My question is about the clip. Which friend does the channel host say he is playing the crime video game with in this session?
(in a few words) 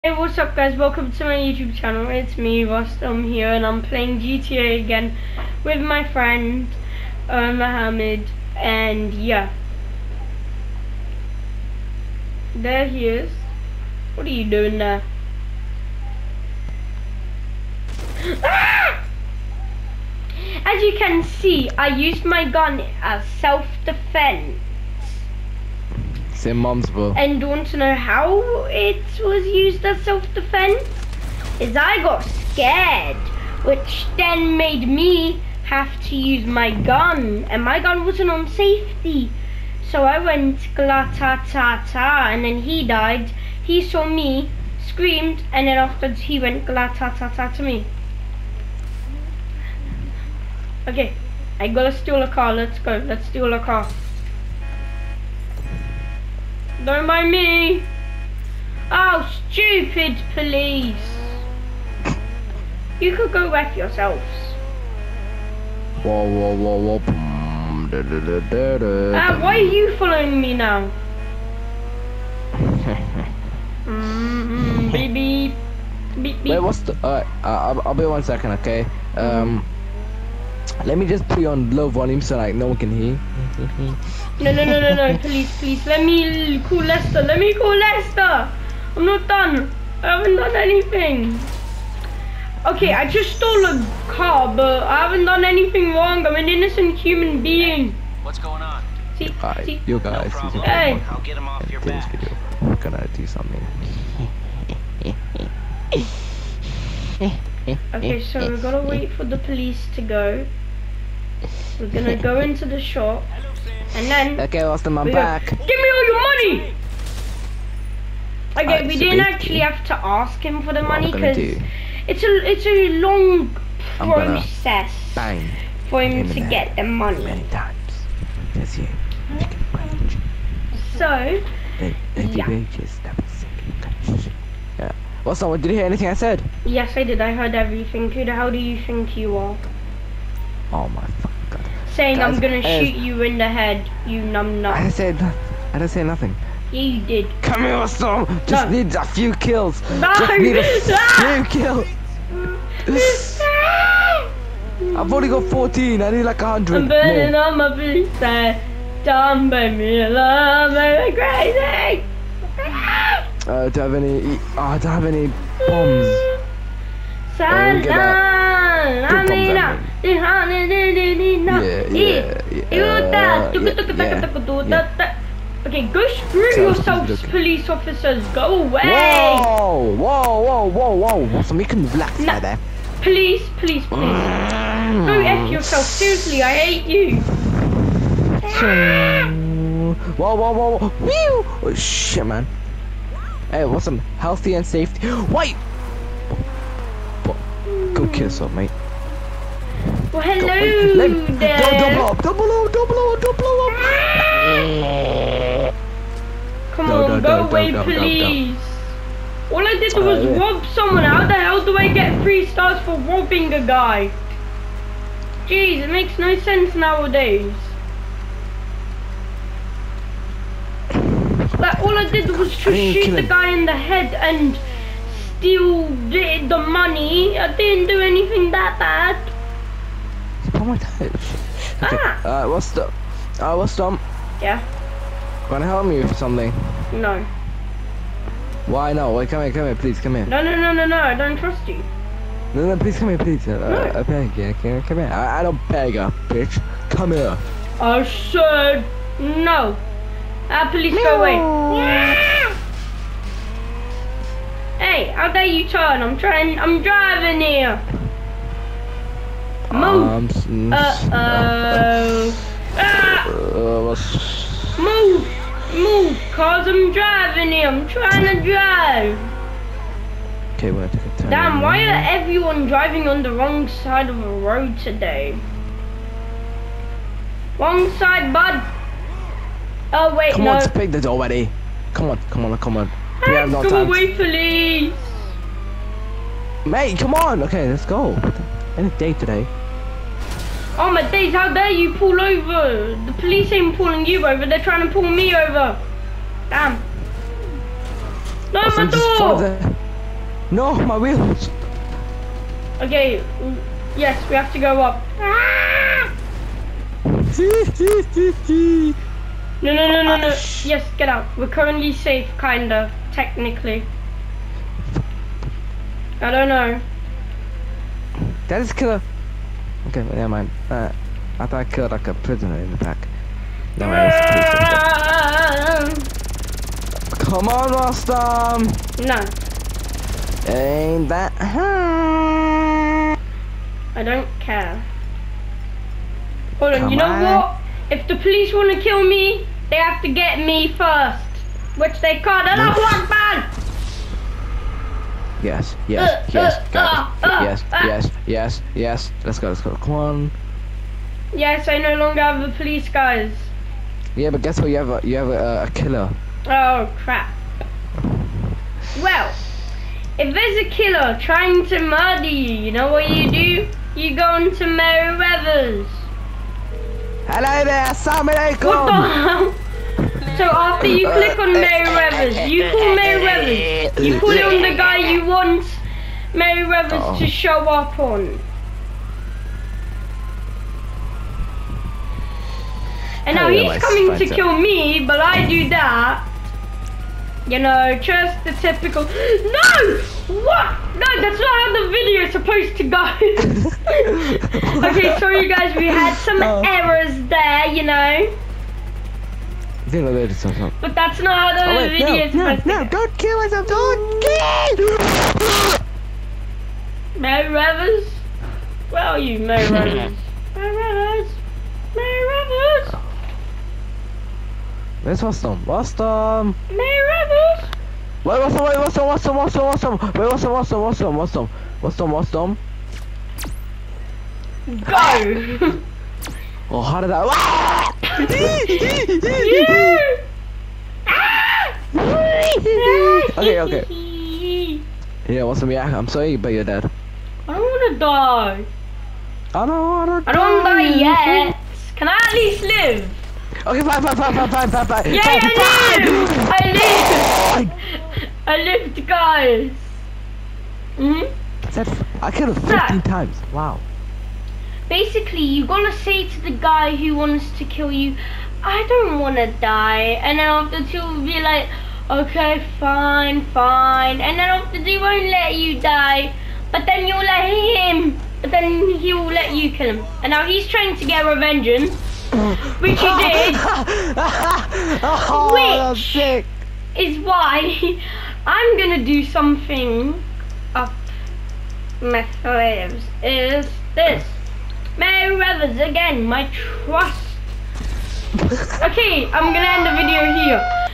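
Mohammed.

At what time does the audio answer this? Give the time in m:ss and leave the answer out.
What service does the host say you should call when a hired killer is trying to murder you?
6:04.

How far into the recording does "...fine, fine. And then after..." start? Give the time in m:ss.
7:42.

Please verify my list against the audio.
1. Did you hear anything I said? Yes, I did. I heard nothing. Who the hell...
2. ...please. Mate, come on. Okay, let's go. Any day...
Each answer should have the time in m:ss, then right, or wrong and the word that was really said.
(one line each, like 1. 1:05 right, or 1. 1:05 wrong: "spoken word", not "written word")
1. 2:15 wrong: "everything", not "nothing"
2. 4:44 right.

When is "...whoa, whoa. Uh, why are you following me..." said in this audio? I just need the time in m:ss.
1:06.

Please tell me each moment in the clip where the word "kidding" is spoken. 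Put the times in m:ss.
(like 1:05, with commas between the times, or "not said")
not said.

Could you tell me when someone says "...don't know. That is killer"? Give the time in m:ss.
5:16.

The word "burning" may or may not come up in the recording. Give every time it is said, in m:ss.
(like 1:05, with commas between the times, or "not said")
2:36.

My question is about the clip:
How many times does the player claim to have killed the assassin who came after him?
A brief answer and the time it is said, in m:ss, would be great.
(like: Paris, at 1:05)
15, at 7:32.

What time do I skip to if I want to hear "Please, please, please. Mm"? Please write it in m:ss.
3:03.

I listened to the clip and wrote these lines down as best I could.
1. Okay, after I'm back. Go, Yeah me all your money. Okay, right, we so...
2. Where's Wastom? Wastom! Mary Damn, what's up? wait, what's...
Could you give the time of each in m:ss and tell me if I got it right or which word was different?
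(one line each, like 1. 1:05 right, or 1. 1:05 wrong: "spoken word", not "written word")
1. 1:54 wrong: "Give", not "Yeah"
2. 6:55 wrong: "Wait", not "Damn".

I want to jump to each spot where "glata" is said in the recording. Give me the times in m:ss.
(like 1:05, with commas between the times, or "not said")
0:40, 0:46.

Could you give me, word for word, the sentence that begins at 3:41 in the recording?
I, all I did was to shoot the guy in the head and steal the, the money.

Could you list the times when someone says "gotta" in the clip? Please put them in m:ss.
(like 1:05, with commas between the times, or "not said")
0:51, 7:35.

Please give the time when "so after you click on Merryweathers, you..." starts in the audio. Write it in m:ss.
6:10.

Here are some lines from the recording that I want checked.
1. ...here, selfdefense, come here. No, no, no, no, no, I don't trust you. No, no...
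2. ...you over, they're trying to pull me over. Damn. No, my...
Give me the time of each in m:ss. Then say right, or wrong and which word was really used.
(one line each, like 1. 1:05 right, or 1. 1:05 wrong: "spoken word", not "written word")
1. 3:59 wrong: "please", not "selfdefense"
2. 4:54 right.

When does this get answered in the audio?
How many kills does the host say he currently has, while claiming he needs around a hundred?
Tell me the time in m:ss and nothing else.
2:35.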